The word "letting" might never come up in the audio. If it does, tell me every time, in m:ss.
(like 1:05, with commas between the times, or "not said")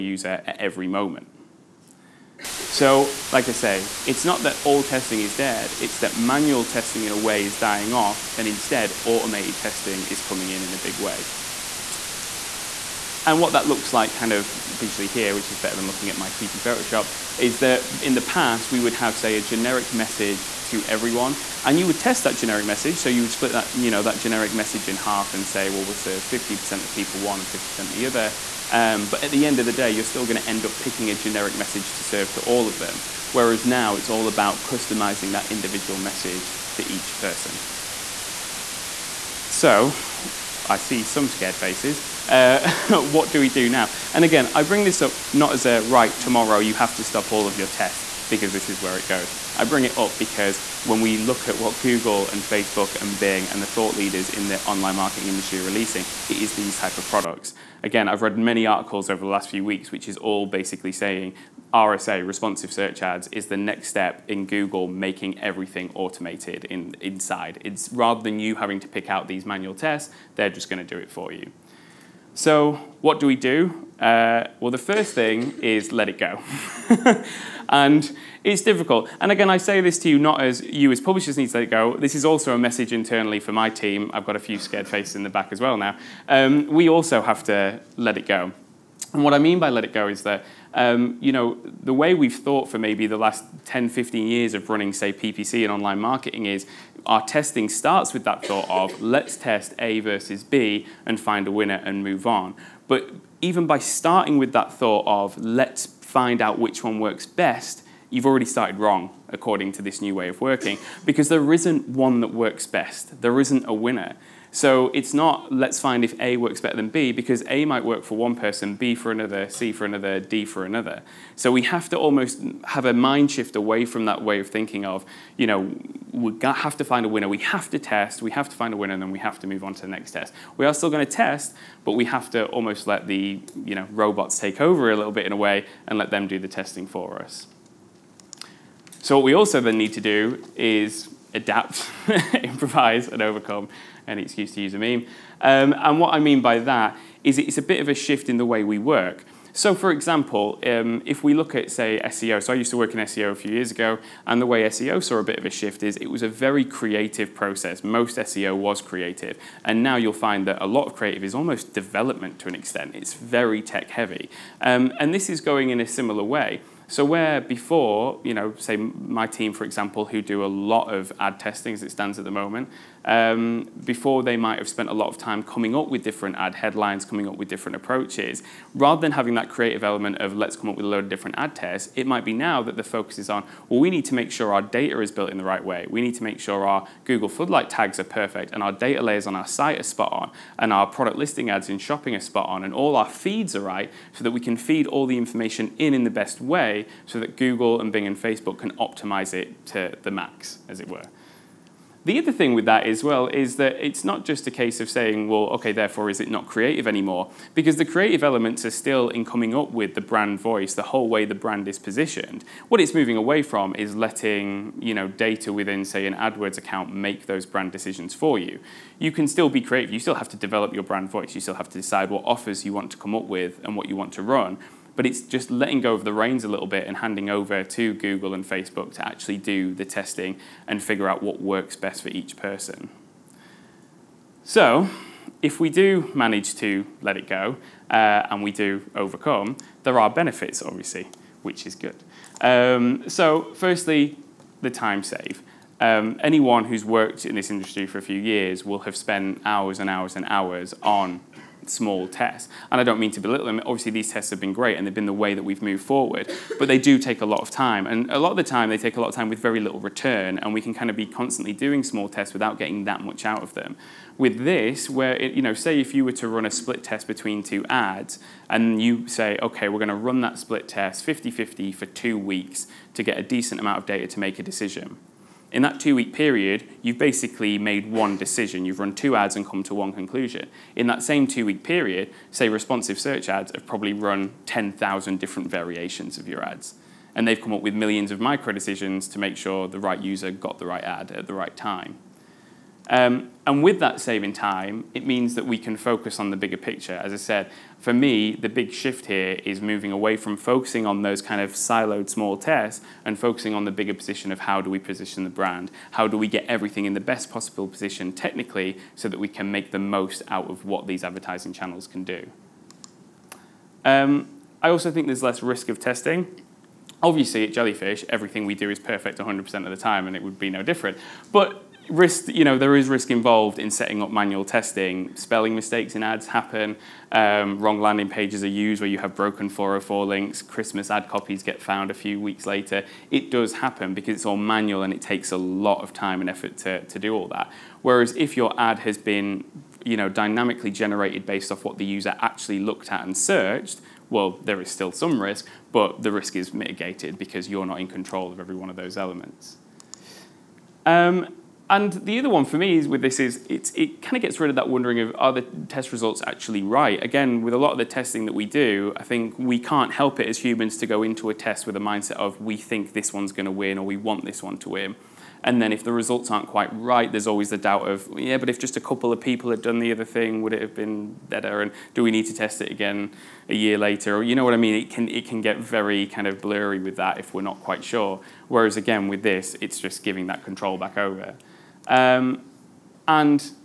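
3:33, 3:45.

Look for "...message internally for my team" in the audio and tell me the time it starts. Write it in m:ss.
1:22.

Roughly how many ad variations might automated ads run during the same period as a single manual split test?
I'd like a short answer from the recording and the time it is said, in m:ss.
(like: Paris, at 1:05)
10,000, at 4:44.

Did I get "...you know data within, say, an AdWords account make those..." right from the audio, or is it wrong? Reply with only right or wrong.
right.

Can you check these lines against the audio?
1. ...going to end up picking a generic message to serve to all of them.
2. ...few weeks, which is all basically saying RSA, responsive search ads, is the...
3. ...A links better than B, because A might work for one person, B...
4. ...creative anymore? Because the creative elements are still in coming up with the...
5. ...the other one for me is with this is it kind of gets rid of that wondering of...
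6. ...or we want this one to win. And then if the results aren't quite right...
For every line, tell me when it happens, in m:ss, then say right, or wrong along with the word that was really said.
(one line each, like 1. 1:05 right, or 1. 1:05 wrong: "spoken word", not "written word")
1. 0:30 right
2. 0:59 right
3. 1:56 wrong: "works", not "links"
4. 3:26 right
5. 5:51 right
6. 6:03 right.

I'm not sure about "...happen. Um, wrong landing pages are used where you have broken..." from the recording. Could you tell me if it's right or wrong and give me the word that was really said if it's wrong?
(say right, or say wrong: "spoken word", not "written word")
right.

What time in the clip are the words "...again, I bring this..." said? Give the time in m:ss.
0:44.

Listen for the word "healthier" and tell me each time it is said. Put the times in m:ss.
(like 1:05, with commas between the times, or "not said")
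not said.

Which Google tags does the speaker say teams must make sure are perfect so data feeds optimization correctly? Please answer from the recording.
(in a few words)
Floodlight tags.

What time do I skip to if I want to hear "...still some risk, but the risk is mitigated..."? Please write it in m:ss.
5:44.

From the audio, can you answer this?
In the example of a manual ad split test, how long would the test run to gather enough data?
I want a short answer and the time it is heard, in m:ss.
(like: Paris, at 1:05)
two weeks, at 4:31.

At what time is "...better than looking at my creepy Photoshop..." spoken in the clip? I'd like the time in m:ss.
0:15.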